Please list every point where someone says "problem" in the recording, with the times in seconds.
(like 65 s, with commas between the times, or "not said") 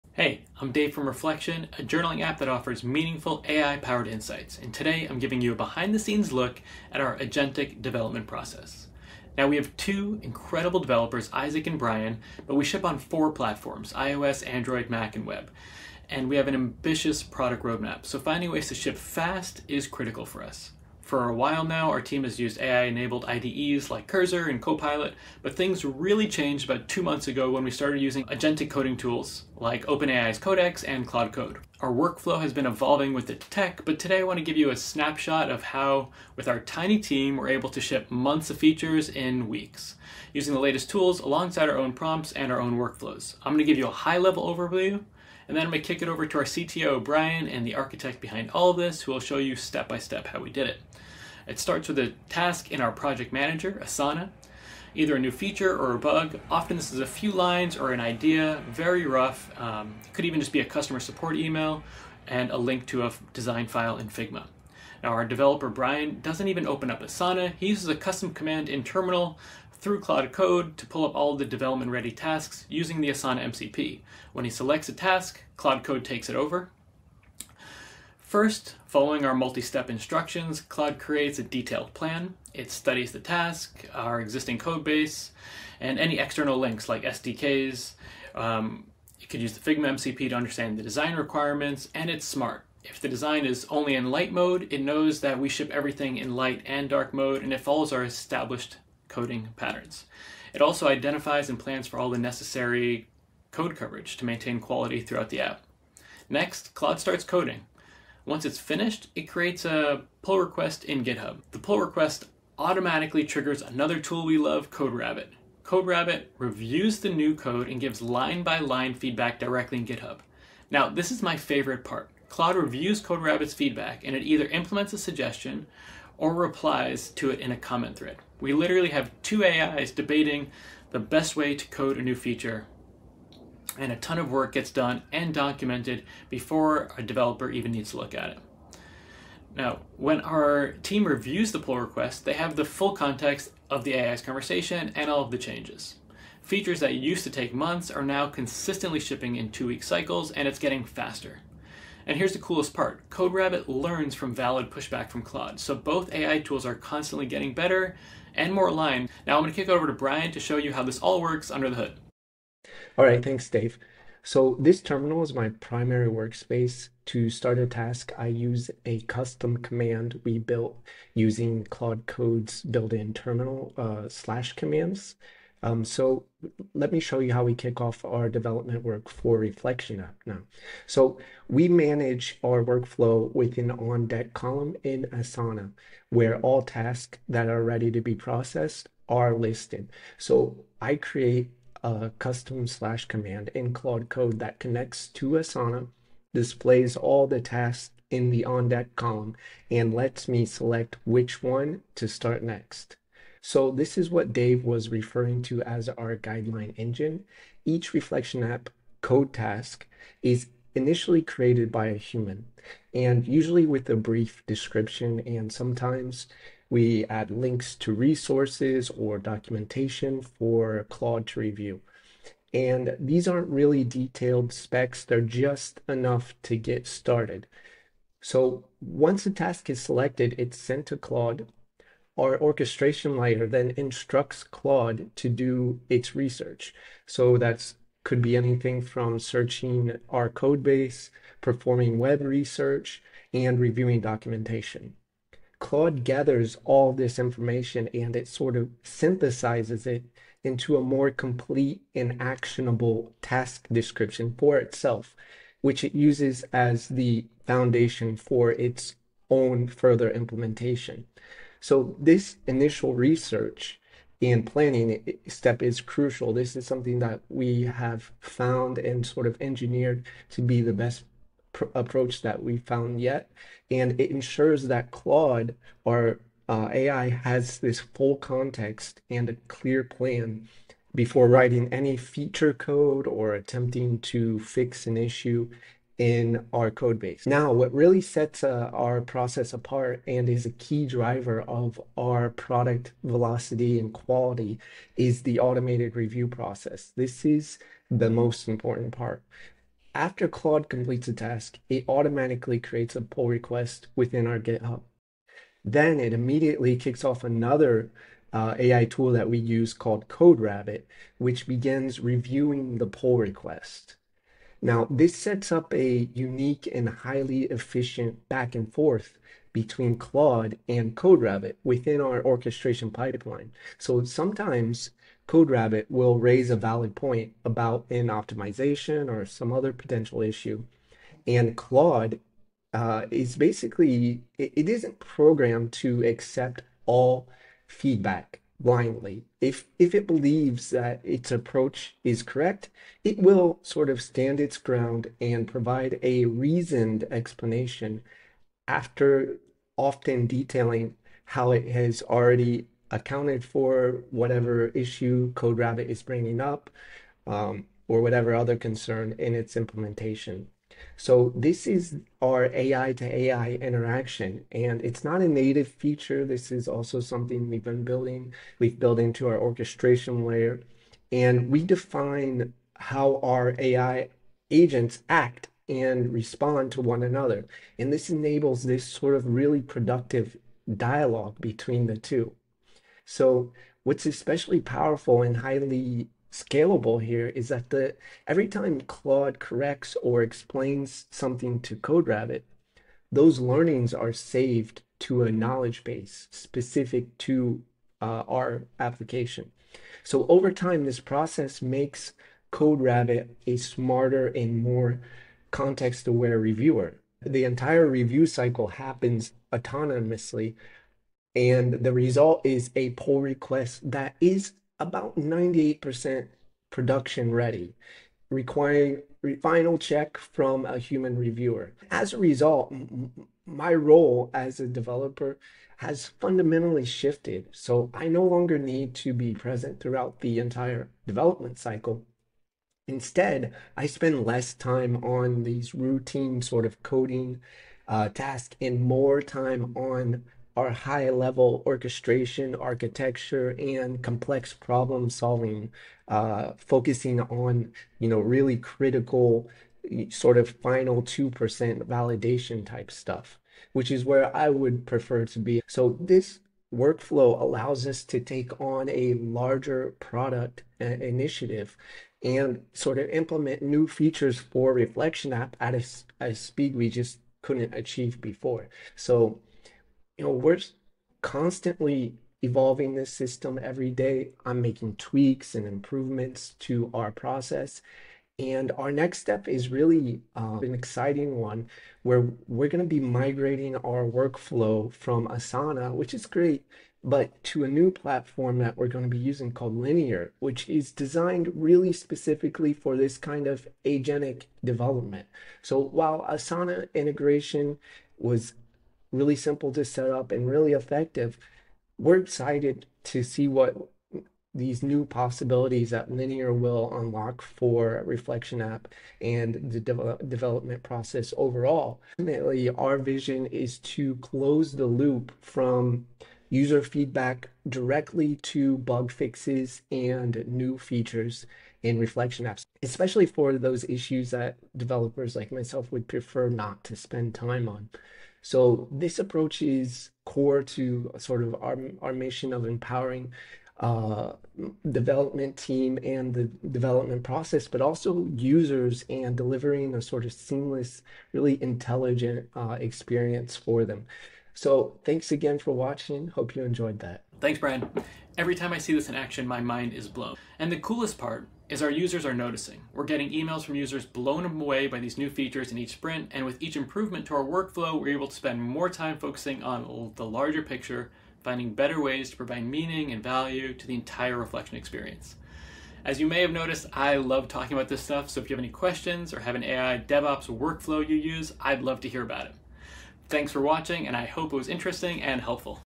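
444 s.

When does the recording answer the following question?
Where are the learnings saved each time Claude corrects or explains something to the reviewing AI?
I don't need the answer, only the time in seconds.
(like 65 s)
395 s.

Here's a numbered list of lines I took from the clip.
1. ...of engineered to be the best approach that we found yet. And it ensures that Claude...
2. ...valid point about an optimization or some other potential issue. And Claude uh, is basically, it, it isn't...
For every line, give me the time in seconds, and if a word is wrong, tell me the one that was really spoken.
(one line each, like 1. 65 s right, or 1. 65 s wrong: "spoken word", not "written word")
1. 269 s right
2. 326 s right.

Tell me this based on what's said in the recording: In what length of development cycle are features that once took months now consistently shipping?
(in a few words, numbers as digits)
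two week cycles.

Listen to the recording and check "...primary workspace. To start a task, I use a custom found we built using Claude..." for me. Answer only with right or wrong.
wrong.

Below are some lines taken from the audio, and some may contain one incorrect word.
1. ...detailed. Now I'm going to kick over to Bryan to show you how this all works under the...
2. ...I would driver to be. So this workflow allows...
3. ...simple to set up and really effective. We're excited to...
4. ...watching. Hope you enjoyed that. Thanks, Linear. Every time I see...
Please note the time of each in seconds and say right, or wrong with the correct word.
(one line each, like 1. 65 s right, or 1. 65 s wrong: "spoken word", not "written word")
1. 158 s wrong: "aligned", not "detailed"
2. 454 s wrong: "prefer", not "driver"
3. 499 s right
4. 545 s wrong: "Bryan", not "Linear".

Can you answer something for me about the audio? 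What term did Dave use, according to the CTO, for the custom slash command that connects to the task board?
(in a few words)
guideline engine.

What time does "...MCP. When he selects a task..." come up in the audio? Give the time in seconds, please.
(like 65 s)
73 s.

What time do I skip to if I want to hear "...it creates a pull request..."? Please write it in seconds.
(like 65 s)
109 s.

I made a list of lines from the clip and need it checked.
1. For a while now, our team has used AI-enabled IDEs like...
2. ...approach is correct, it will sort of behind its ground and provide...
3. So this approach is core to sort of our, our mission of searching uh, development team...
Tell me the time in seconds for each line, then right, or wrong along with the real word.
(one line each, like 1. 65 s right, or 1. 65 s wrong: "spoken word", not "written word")
1. 21 s right
2. 341 s wrong: "stand", not "behind"
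3. 528 s wrong: "empowering", not "searching".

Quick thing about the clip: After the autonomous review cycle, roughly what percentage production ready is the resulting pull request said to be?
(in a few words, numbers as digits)
98%.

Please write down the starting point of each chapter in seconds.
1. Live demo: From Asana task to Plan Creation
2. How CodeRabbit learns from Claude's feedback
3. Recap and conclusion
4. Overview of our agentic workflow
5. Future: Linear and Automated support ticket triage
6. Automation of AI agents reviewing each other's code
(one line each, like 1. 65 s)
1. 162 s
2. 348 s
3. 547 s
4. 43 s
5. 478 s
6. 287 s.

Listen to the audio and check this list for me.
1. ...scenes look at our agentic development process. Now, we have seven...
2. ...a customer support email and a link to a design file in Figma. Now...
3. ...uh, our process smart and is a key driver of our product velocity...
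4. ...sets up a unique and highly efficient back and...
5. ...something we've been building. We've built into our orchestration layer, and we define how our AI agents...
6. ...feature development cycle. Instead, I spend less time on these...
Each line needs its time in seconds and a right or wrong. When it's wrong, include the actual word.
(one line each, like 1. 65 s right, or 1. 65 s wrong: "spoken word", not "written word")
1. 5 s wrong: "two", not "seven"
2. 60 s right
3. 288 s wrong: "apart", not "smart"
4. 315 s right
5. 366 s right
6. 430 s wrong: "entire", not "feature".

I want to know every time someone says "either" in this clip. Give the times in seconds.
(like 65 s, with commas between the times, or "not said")
54 s, 124 s.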